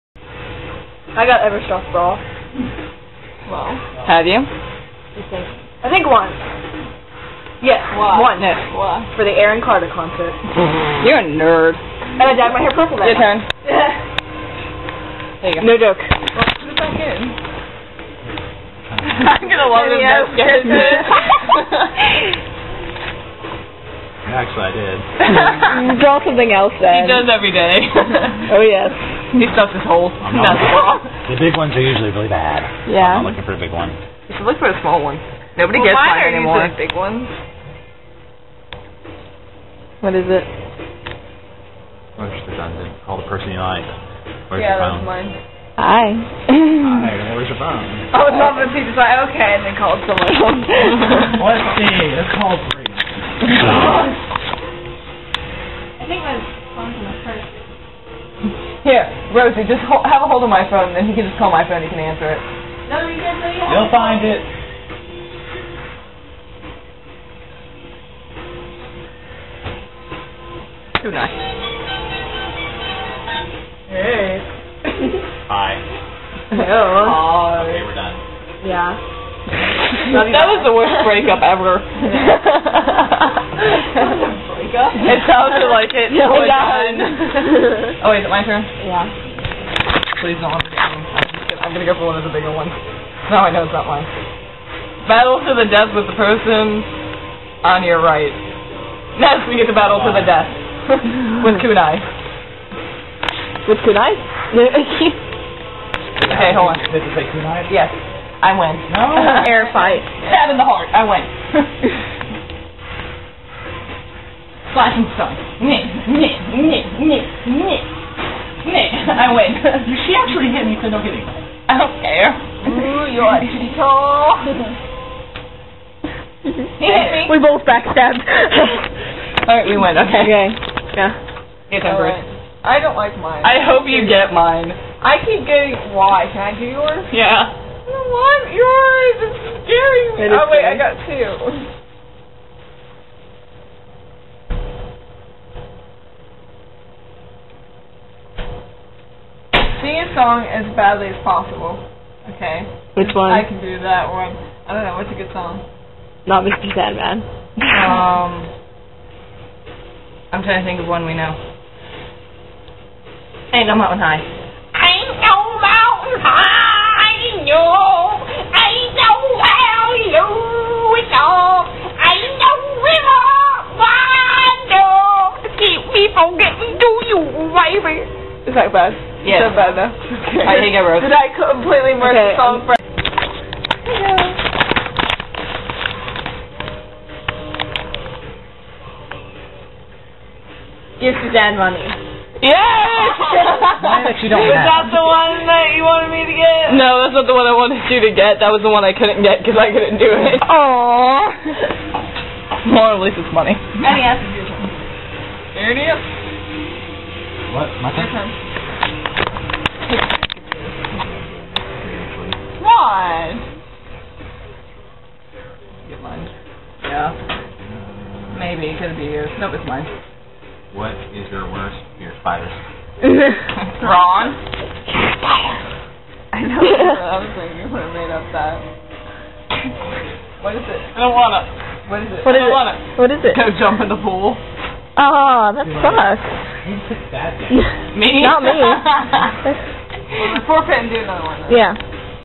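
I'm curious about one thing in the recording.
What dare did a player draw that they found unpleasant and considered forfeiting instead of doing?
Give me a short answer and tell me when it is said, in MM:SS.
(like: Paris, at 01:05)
Jump in the pool, at 03:53.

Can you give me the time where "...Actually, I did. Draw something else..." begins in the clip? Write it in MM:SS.
00:24.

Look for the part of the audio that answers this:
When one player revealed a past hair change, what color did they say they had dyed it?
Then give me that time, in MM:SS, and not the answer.
00:12.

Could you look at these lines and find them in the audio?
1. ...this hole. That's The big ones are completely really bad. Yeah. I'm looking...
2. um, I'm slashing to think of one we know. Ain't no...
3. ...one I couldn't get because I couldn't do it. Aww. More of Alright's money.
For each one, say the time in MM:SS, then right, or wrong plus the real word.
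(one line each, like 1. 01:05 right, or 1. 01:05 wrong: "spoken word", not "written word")
1. 00:29 wrong: "usually", not "completely"
2. 02:37 wrong: "trying", not "slashing"
3. 03:18 wrong: "Lisa", not "Alright".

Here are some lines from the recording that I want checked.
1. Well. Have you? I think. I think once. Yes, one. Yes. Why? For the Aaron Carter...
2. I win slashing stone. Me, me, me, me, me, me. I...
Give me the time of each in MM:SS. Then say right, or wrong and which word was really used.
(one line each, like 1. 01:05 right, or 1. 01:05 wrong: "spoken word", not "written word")
1. 00:03 right
2. 01:50 right.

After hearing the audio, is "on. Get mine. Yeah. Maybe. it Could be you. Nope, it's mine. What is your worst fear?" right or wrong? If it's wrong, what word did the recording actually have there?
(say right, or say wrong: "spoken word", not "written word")
right.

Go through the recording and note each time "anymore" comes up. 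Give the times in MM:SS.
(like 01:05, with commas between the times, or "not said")
00:36.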